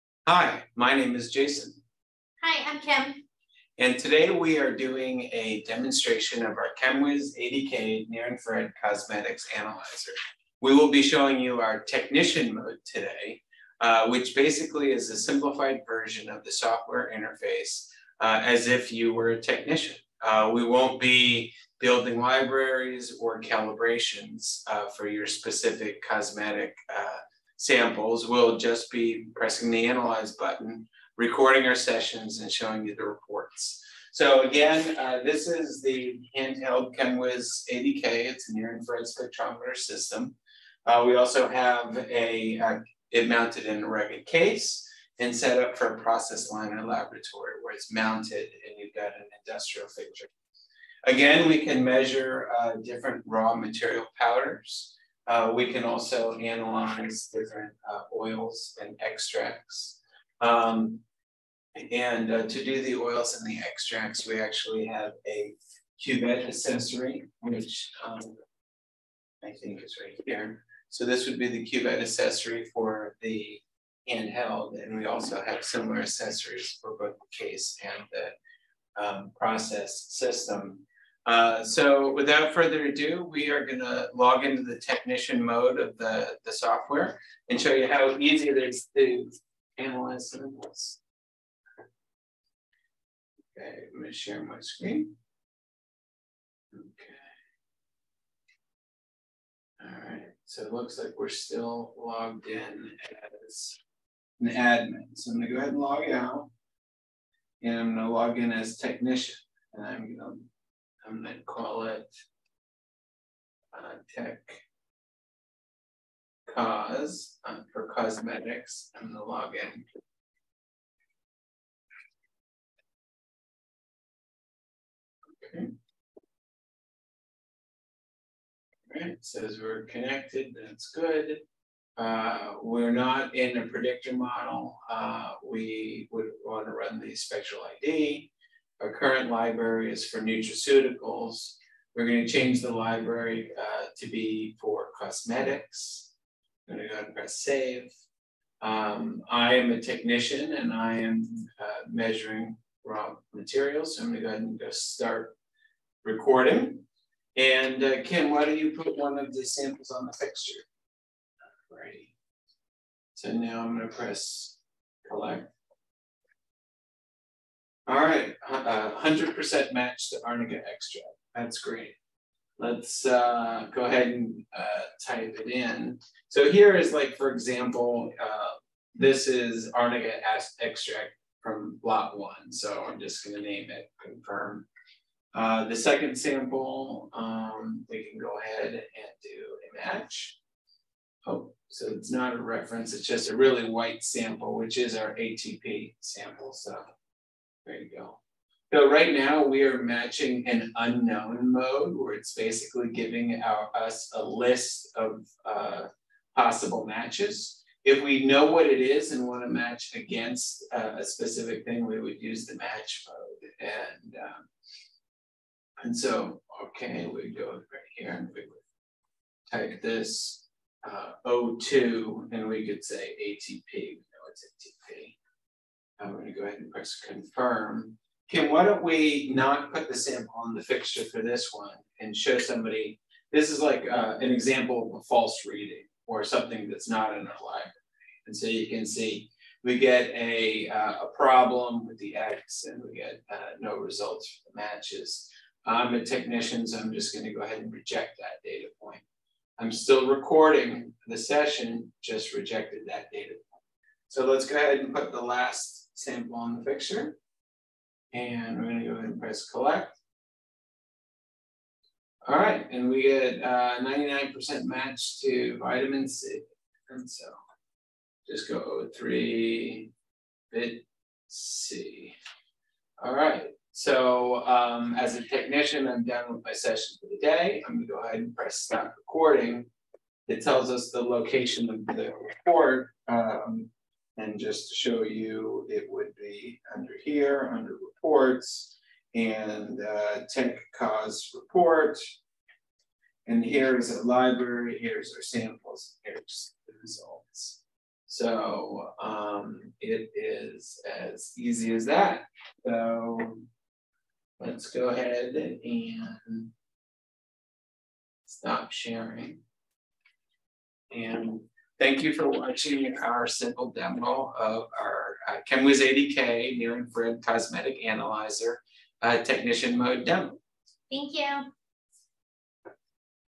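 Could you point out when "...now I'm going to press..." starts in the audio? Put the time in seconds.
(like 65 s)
163 s.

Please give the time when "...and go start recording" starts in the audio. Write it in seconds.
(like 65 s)
154 s.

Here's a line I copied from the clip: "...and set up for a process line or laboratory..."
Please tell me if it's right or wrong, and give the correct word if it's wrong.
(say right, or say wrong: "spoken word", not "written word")
right.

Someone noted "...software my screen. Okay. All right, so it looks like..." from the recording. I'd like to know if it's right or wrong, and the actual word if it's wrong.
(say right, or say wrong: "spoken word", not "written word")
wrong: "share", not "software".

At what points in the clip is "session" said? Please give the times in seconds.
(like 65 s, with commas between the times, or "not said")
31 s, 251 s, 276 s.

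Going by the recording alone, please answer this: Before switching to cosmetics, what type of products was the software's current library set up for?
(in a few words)
Nutraceuticals.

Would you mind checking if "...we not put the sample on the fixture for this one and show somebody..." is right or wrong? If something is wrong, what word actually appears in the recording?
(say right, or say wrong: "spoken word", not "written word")
right.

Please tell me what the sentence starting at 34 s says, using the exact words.
So again, uh, this is the handheld ChemWiz ADK.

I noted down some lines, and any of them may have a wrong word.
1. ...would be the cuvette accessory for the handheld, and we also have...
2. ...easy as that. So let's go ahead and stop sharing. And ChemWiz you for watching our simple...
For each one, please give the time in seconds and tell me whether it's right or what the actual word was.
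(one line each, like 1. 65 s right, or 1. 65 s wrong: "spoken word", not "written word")
1. 71 s right
2. 301 s wrong: "Thank", not "ChemWiz".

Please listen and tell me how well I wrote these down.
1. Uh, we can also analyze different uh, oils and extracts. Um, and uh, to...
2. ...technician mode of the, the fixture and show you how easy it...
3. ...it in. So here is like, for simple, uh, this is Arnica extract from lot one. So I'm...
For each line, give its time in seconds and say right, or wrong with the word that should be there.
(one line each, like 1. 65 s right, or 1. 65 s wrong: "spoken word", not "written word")
1. 55 s right
2. 84 s wrong: "software", not "fixture"
3. 175 s wrong: "example", not "simple".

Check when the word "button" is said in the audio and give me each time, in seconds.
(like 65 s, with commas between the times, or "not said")
30 s.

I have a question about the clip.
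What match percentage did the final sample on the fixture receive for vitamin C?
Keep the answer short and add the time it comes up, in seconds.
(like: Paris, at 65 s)
99%, at 263 s.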